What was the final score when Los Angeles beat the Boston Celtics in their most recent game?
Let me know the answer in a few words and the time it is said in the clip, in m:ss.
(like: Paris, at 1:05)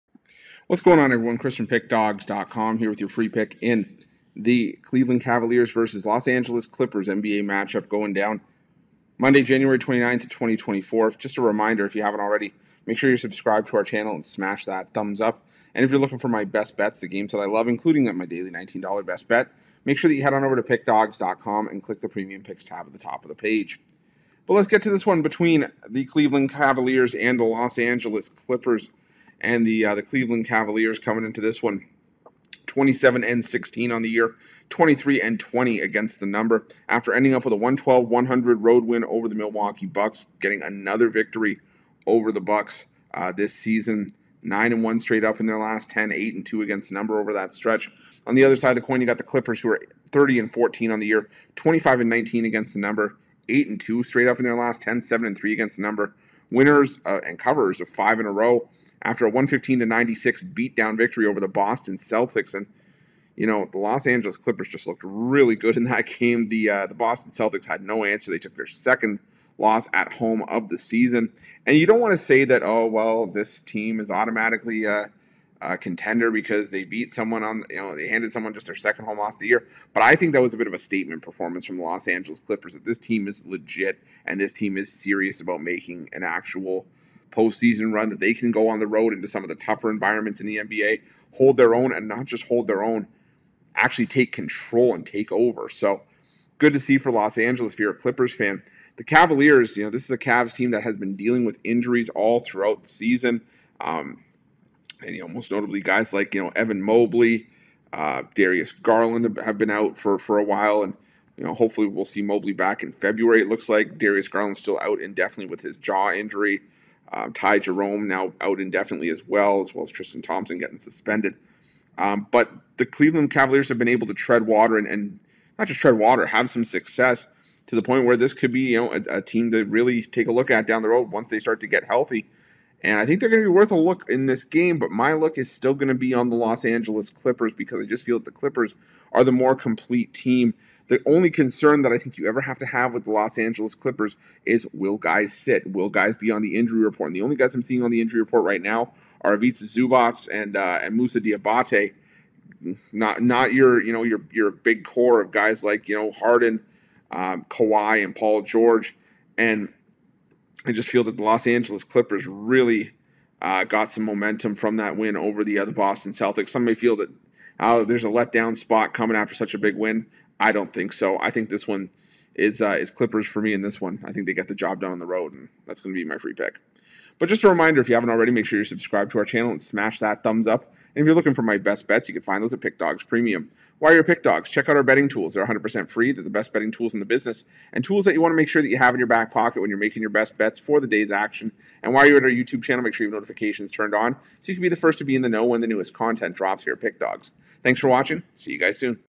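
115-96, at 0:59.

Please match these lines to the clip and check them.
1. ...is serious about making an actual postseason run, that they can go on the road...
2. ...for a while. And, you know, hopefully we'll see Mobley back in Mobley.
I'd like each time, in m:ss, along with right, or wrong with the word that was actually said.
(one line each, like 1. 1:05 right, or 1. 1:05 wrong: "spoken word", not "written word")
1. 1:24 right
2. 1:50 wrong: "February", not "Mobley".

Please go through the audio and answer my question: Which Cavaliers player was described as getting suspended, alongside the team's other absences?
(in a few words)
Tristan Thompson.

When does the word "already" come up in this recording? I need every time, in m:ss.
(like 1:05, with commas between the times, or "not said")
0:12, 2:58.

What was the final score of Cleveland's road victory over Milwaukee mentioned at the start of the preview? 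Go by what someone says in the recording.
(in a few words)
112-100.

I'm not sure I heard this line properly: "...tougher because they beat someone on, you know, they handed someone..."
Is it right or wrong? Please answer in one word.
wrong.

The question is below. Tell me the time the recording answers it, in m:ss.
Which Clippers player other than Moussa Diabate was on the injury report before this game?
2:29.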